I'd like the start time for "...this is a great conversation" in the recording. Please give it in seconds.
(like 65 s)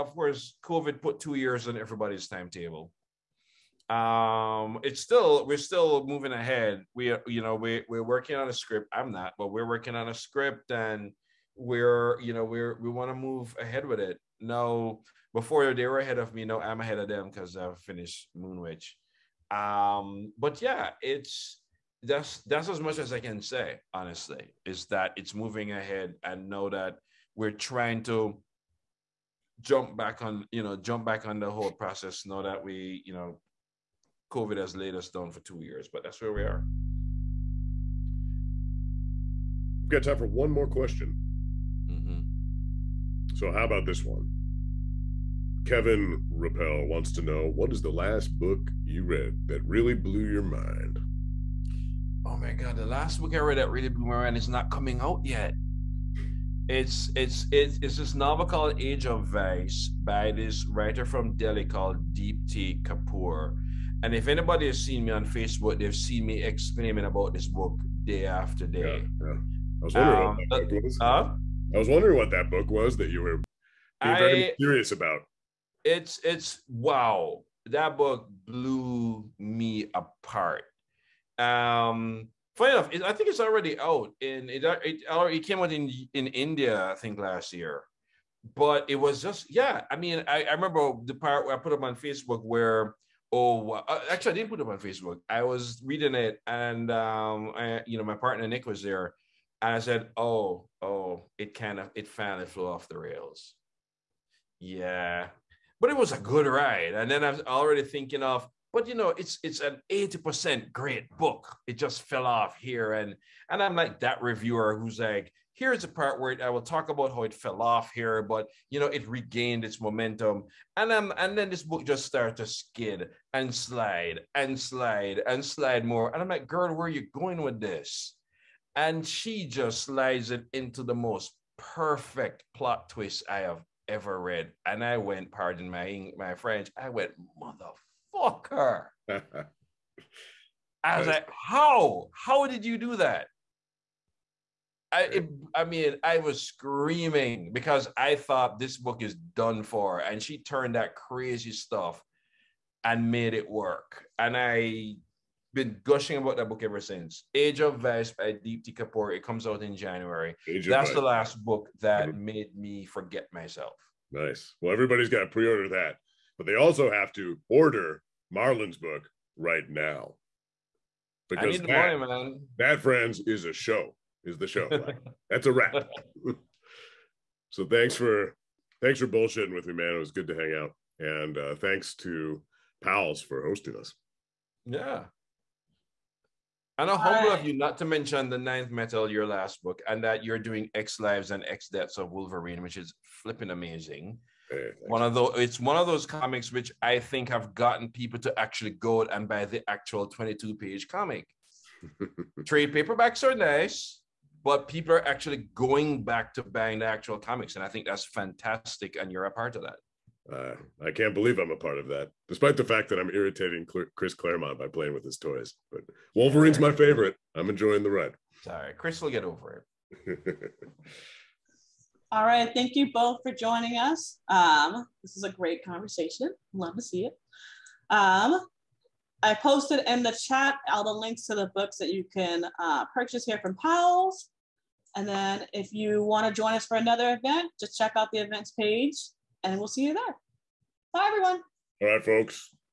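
225 s.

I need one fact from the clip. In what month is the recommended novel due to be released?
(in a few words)
January.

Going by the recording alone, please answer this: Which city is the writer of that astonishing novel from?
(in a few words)
Delhi.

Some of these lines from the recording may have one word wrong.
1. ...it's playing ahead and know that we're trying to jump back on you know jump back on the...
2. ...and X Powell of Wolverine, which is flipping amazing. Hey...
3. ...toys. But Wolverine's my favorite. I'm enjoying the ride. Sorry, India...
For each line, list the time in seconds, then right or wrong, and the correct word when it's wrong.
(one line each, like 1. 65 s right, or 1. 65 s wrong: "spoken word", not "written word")
1. 25 s wrong: "moving", not "playing"
2. 191 s wrong: "Deaths", not "Powell"
3. 215 s wrong: "Chris", not "India".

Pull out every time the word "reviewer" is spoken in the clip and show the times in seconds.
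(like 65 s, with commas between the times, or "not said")
114 s.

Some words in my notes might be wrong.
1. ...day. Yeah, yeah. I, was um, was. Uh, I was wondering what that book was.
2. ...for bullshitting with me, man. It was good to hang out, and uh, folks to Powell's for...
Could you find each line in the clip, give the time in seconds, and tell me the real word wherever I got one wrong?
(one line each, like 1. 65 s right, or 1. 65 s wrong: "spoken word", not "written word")
1. 68 s right
2. 178 s wrong: "thanks", not "folks".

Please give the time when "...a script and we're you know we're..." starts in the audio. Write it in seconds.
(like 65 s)
10 s.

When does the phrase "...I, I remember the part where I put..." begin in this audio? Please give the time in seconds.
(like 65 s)
90 s.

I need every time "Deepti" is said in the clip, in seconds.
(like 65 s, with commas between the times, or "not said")
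62 s, 158 s.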